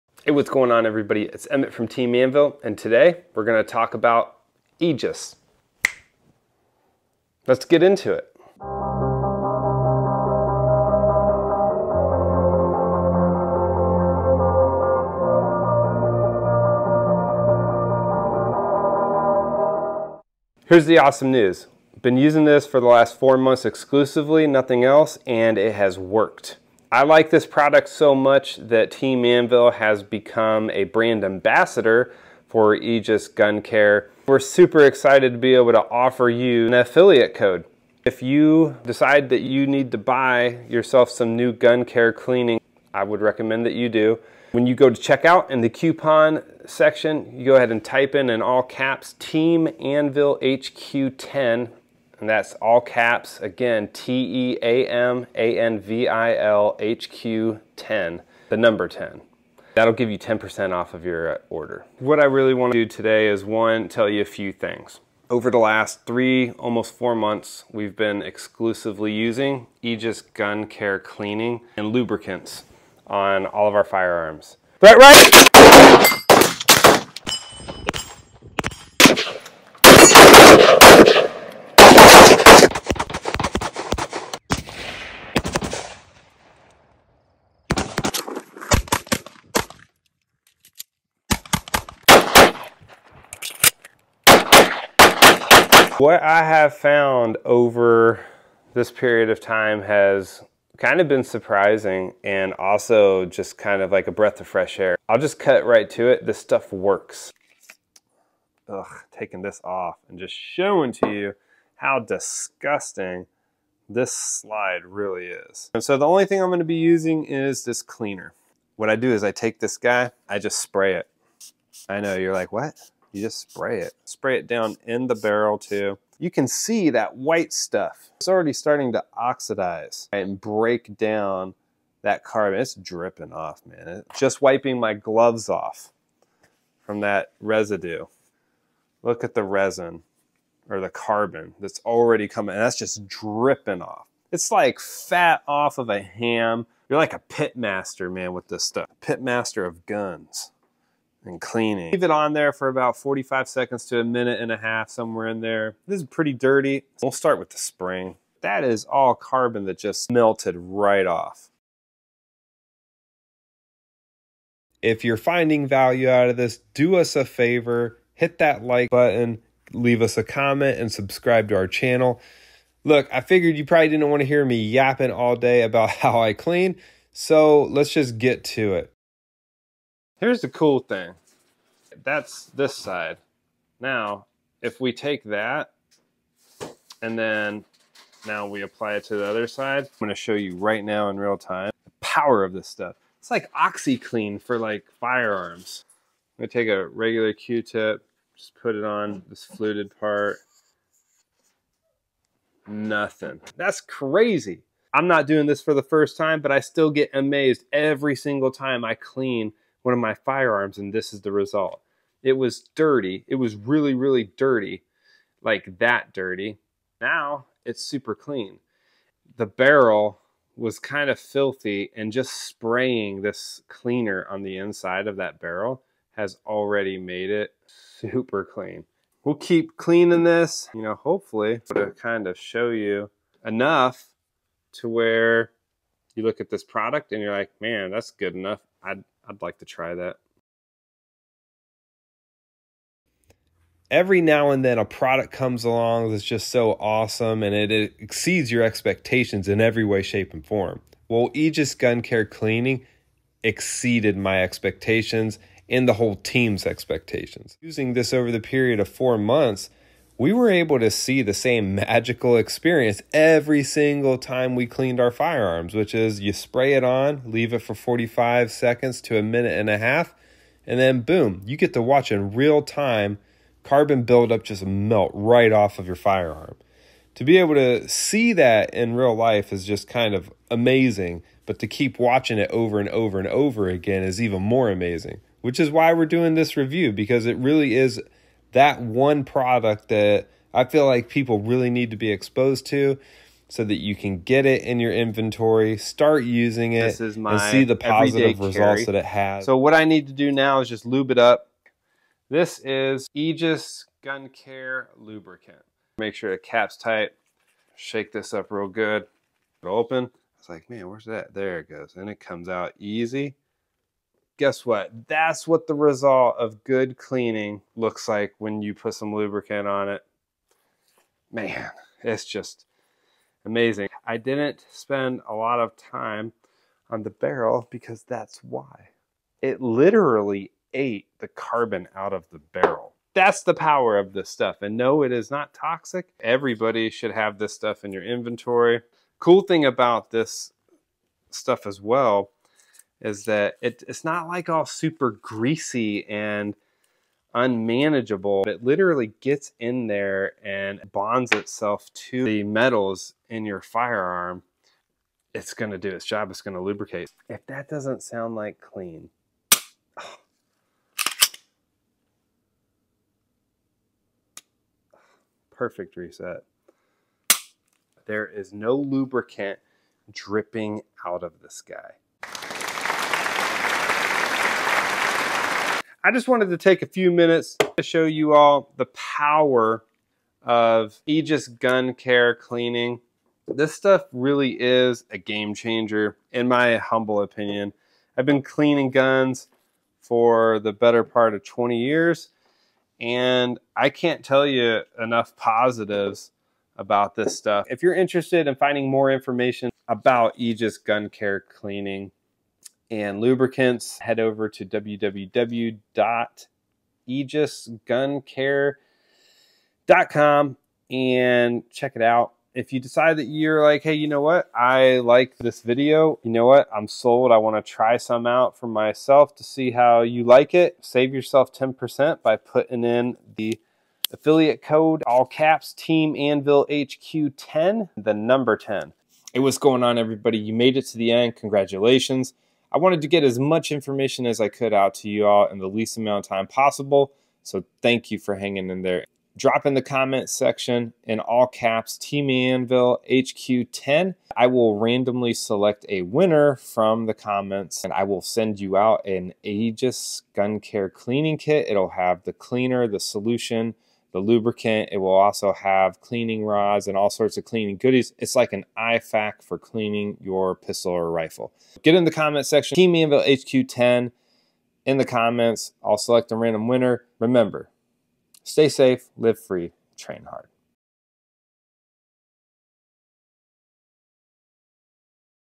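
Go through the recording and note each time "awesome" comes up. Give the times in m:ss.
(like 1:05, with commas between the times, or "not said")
0:20, 4:06.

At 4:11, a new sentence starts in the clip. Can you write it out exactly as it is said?
Well, Aegis Gun Care Cleaning exceeded my expectations and the whole team's expectations.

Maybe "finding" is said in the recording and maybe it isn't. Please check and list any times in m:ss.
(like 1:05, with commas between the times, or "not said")
2:45, 6:38.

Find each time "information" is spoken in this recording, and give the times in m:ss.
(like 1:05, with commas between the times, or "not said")
6:39, 7:13.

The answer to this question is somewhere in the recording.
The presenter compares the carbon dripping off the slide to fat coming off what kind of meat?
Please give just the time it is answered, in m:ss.
2:26.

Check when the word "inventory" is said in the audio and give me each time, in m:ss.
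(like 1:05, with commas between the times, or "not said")
4:54, 5:38.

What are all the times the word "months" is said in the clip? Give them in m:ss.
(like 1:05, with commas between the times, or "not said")
0:23, 1:07, 4:19.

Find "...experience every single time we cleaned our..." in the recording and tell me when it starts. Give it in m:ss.
4:22.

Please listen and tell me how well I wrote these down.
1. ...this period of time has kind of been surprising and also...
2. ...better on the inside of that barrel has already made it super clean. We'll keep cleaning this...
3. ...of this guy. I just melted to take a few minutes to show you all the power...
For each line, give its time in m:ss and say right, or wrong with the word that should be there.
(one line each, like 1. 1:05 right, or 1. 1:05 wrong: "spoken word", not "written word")
1. 1:38 right
2. 3:43 wrong: "cleaner", not "better"
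3. 6:11 wrong: "wanted", not "melted".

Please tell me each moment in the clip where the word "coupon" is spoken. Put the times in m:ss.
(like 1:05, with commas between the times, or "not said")
0:45.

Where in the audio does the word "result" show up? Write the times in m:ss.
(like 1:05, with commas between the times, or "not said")
3:31, 4:58, 5:15.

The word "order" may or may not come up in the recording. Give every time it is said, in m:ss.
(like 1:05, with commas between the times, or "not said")
1:01.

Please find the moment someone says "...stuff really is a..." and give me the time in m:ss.
6:23.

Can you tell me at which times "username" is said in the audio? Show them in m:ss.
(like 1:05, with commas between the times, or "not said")
not said.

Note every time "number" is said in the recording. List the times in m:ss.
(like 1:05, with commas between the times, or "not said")
0:58, 7:08.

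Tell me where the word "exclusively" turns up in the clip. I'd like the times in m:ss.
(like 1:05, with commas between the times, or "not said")
0:23, 1:08.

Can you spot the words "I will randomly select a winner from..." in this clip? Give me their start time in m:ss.
7:24.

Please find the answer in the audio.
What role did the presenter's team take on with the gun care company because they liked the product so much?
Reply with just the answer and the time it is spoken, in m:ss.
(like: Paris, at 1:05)
Brand ambassador, at 0:30.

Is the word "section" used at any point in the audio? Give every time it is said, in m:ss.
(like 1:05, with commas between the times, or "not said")
0:46, 7:20, 7:42.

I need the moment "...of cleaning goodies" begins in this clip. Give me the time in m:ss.
7:37.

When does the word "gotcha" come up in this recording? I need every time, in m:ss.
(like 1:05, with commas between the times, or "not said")
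not said.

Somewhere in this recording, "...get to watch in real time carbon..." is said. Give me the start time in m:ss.
4:31.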